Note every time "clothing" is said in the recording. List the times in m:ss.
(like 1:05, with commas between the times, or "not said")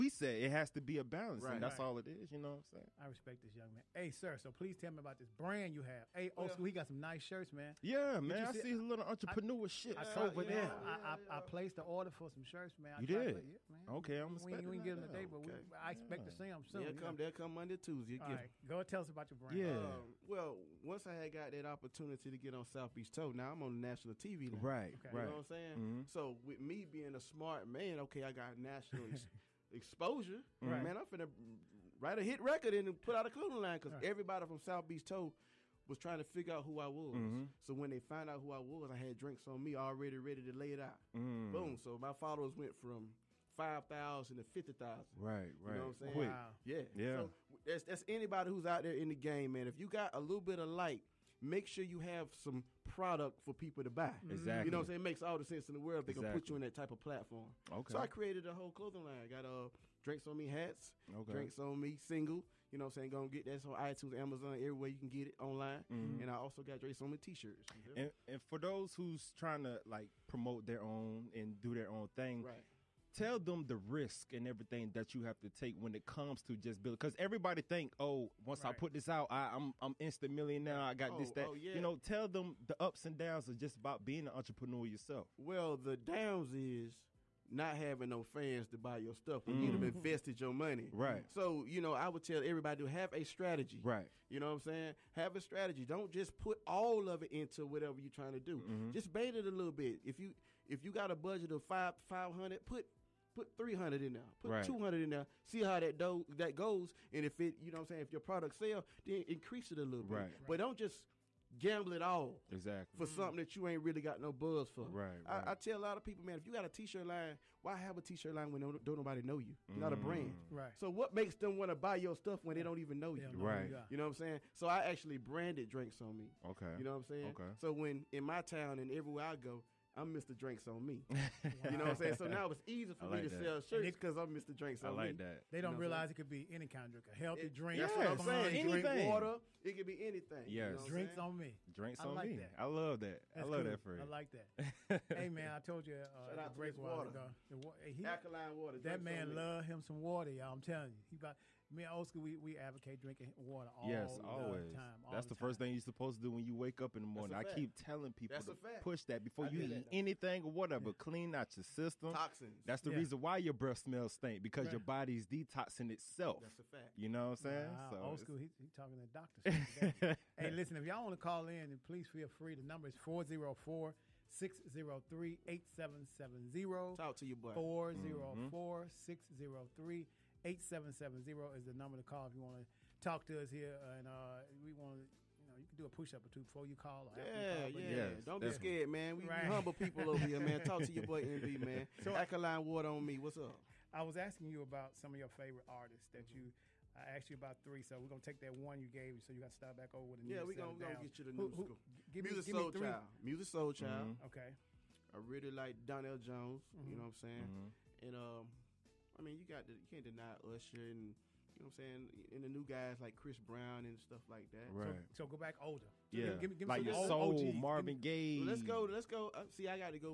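0:33, 0:58.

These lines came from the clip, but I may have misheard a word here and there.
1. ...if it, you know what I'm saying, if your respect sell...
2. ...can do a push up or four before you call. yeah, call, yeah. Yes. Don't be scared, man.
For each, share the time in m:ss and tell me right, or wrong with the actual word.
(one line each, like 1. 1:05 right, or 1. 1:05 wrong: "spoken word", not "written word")
1. 1:47 wrong: "product", not "respect"
2. 3:05 wrong: "two", not "four".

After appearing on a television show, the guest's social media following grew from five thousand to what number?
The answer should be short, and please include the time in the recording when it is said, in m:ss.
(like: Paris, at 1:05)
50,000, at 0:44.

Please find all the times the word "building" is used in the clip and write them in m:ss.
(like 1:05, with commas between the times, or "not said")
1:16.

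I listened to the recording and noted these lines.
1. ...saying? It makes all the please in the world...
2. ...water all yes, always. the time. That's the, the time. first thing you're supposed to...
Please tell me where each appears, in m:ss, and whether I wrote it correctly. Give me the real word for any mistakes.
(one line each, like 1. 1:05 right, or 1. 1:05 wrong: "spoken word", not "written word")
1. 0:54 wrong: "sense", not "please"
2. 2:33 right.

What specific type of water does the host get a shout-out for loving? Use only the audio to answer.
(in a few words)
Alkaline water.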